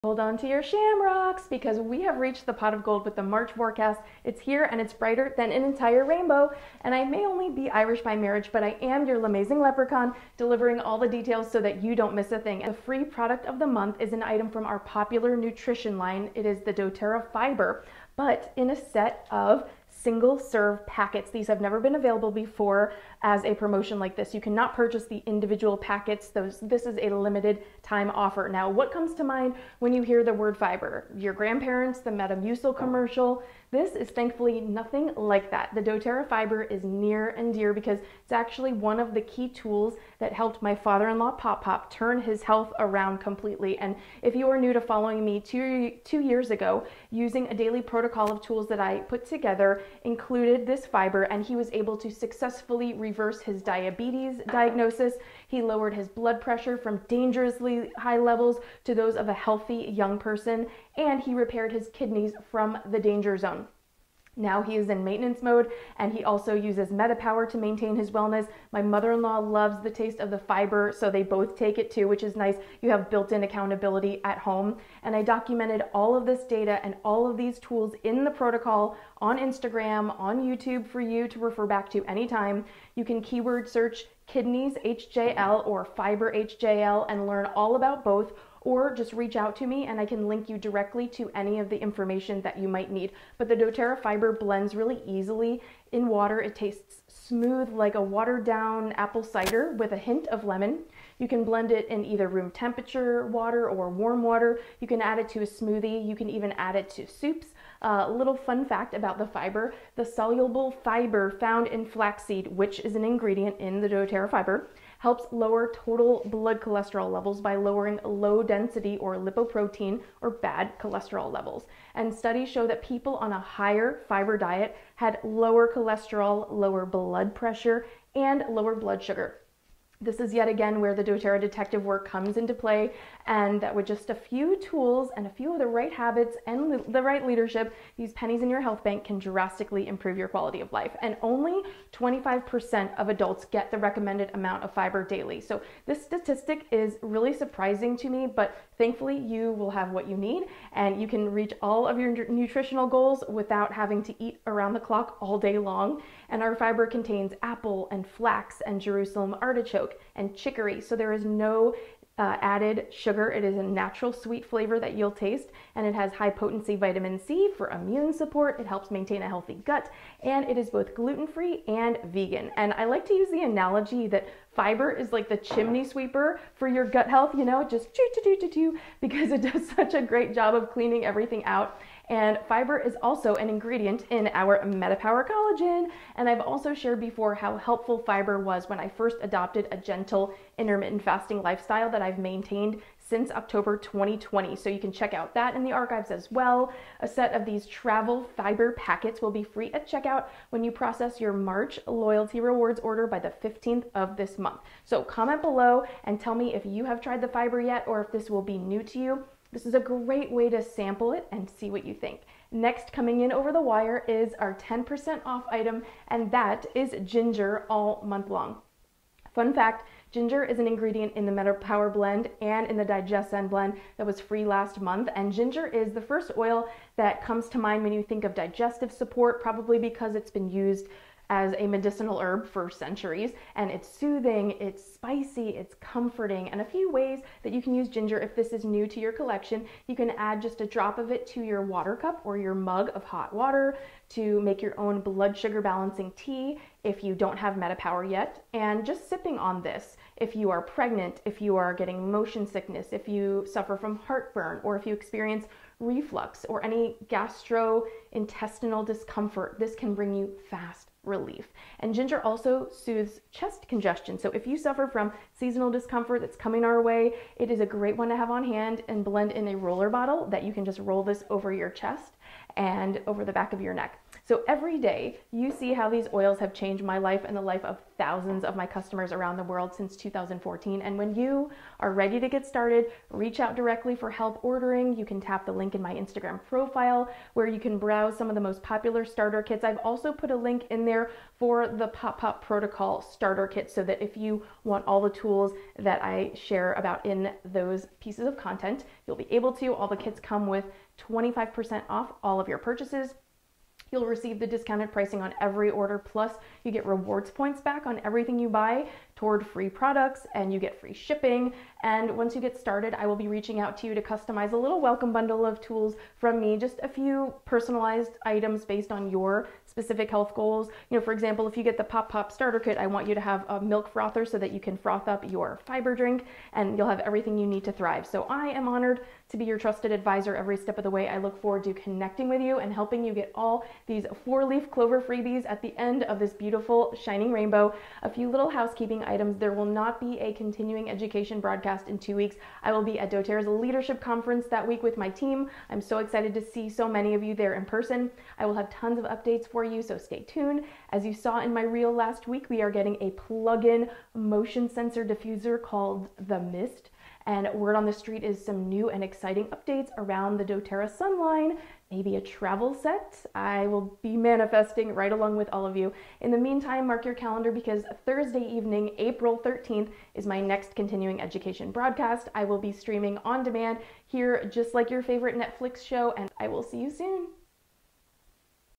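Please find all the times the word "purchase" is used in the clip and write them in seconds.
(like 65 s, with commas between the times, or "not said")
24 s, 302 s.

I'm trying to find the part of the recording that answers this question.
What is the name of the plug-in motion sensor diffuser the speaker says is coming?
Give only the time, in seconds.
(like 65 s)
356 s.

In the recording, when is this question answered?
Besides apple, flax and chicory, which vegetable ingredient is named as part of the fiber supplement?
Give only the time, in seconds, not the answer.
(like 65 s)
158 s.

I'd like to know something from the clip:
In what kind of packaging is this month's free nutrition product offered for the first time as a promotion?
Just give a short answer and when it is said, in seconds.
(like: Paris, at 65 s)
single serve packets, at 19 s.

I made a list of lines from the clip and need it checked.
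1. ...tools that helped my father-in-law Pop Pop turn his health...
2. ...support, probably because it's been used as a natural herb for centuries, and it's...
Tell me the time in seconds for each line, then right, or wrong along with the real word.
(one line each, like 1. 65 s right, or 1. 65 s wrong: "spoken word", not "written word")
1. 39 s right
2. 228 s wrong: "medicinal", not "natural".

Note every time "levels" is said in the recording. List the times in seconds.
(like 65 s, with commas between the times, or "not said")
58 s, 117 s, 121 s.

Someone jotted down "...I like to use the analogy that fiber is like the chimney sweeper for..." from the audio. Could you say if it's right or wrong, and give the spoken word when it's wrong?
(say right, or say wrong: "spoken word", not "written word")
right.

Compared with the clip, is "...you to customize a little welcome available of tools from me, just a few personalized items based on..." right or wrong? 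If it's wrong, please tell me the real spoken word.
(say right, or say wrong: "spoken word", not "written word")
wrong: "bundle", not "available".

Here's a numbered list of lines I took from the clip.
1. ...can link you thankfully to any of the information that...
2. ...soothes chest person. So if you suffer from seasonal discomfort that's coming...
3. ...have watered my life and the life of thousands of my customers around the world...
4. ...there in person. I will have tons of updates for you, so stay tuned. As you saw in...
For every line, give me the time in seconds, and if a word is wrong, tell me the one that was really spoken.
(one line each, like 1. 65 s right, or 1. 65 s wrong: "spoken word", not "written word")
1. 90 s wrong: "directly", not "thankfully"
2. 262 s wrong: "congestion", not "person"
3. 276 s wrong: "changed", not "watered"
4. 347 s right.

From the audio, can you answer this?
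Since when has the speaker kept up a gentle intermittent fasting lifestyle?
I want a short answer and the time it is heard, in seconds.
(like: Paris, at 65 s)
October 2020, at 193 s.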